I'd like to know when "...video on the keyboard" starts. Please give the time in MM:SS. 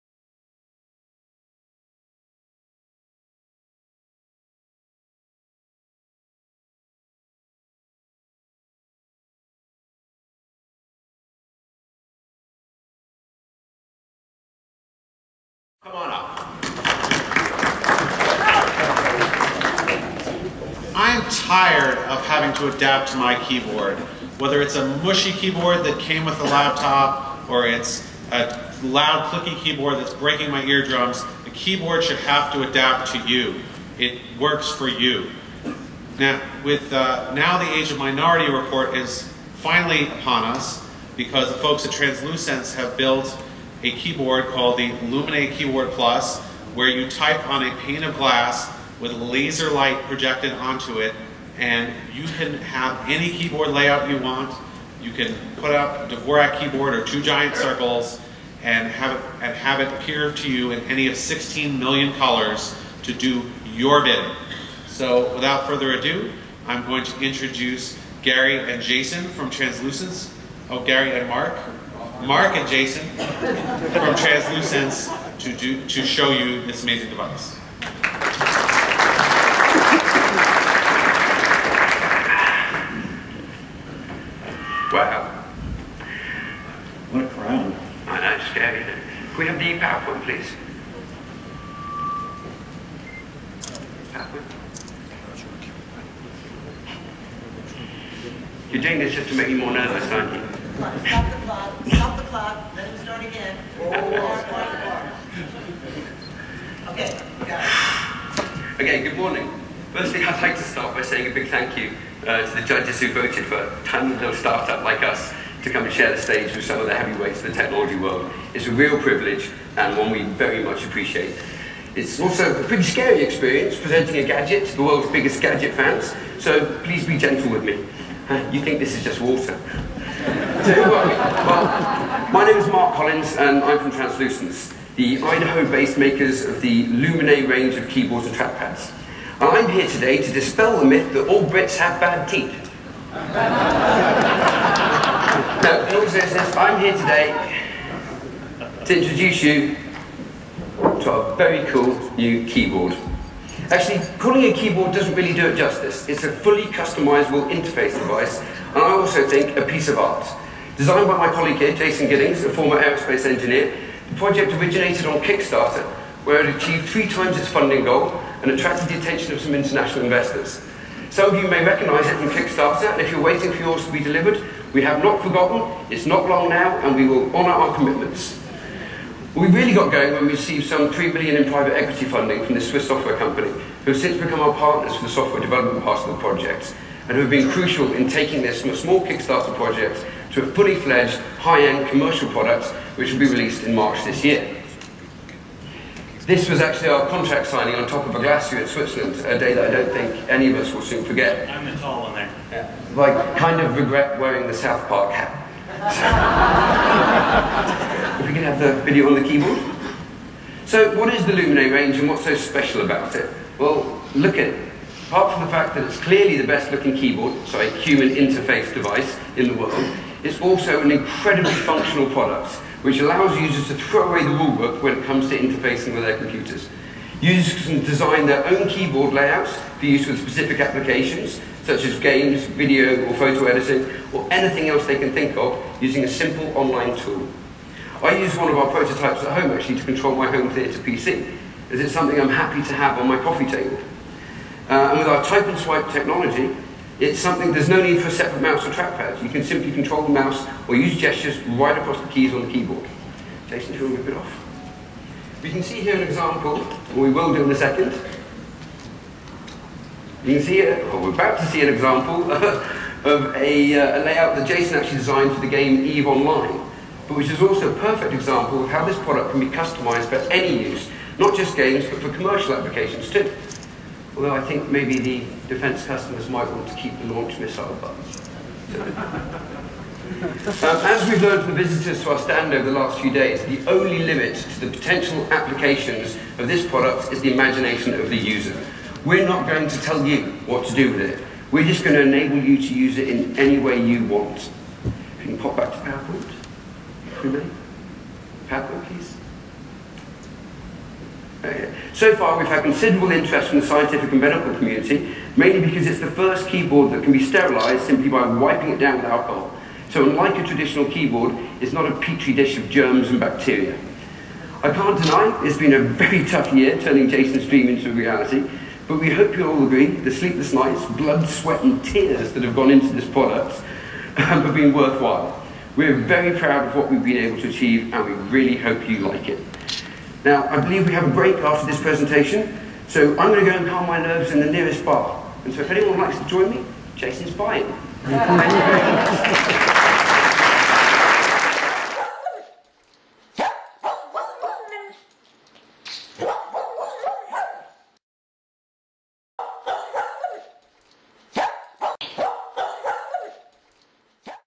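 03:28.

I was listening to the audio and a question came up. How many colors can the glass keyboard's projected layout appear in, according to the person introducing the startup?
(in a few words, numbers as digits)
16 million.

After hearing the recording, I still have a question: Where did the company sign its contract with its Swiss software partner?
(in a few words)
on top of a glacier.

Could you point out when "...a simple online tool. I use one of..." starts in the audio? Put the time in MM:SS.
03:56.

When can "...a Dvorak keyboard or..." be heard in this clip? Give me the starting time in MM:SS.
00:56.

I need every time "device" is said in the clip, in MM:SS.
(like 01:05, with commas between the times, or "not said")
01:17, 02:37, 03:38.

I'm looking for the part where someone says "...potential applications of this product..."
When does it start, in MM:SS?
04:44.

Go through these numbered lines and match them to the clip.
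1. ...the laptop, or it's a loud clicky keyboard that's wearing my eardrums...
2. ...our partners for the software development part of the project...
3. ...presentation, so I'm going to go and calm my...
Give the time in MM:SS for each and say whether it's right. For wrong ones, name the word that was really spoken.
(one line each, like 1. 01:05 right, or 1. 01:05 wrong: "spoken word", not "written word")
1. 00:26 wrong: "breaking", not "wearing"
2. 03:04 right
3. 05:31 right.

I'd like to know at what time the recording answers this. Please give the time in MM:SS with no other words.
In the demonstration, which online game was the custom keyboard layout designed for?
04:25.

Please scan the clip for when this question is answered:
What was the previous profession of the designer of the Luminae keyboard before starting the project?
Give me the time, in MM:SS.
02:42.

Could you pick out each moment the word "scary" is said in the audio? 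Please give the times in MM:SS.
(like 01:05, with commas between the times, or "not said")
01:28, 02:02.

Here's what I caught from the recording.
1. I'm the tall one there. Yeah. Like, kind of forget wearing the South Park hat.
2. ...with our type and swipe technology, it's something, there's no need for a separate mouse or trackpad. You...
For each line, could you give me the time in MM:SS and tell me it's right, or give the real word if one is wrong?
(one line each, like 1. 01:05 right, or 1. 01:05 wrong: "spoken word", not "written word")
1. 03:21 wrong: "regret", not "forget"
2. 04:04 right.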